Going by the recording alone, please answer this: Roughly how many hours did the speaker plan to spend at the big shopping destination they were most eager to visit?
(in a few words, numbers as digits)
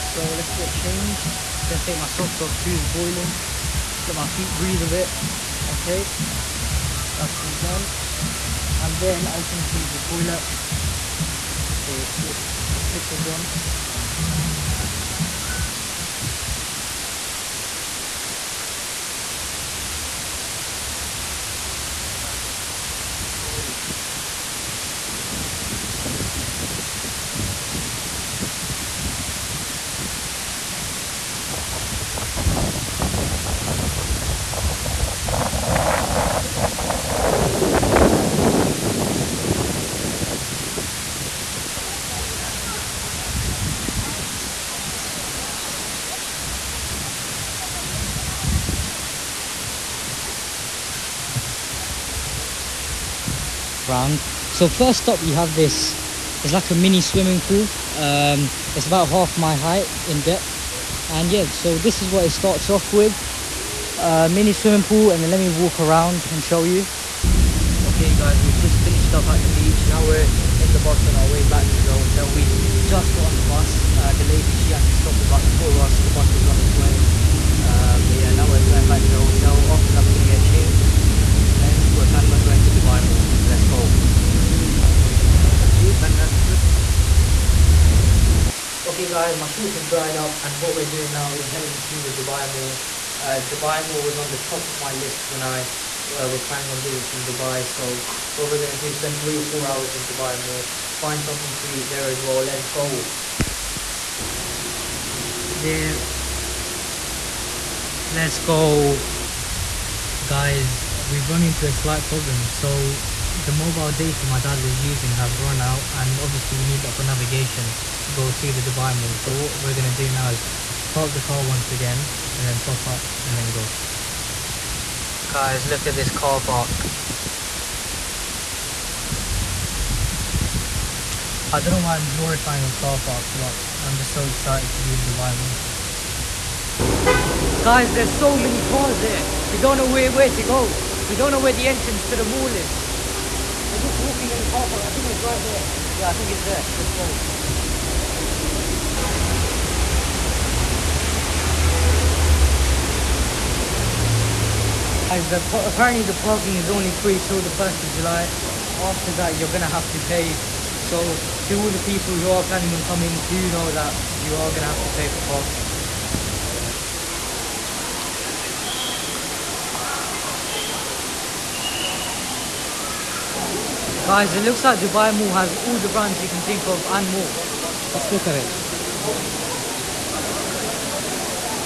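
3 or 4 hours.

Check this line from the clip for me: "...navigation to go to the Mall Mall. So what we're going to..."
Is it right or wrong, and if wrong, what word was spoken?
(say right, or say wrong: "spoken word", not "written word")
wrong: "Dubai", not "Mall".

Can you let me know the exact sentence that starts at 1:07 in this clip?
Okay guys, we've just finished up at the beach.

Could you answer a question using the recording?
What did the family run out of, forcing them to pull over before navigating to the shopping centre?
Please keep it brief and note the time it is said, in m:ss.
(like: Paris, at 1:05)
Mobile data, at 1:53.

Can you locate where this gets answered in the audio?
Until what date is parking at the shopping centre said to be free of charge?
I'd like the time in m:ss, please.
2:37.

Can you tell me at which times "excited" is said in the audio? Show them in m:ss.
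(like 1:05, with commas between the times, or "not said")
2:14.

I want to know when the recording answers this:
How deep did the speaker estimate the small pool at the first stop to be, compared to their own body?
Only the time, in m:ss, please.
0:59.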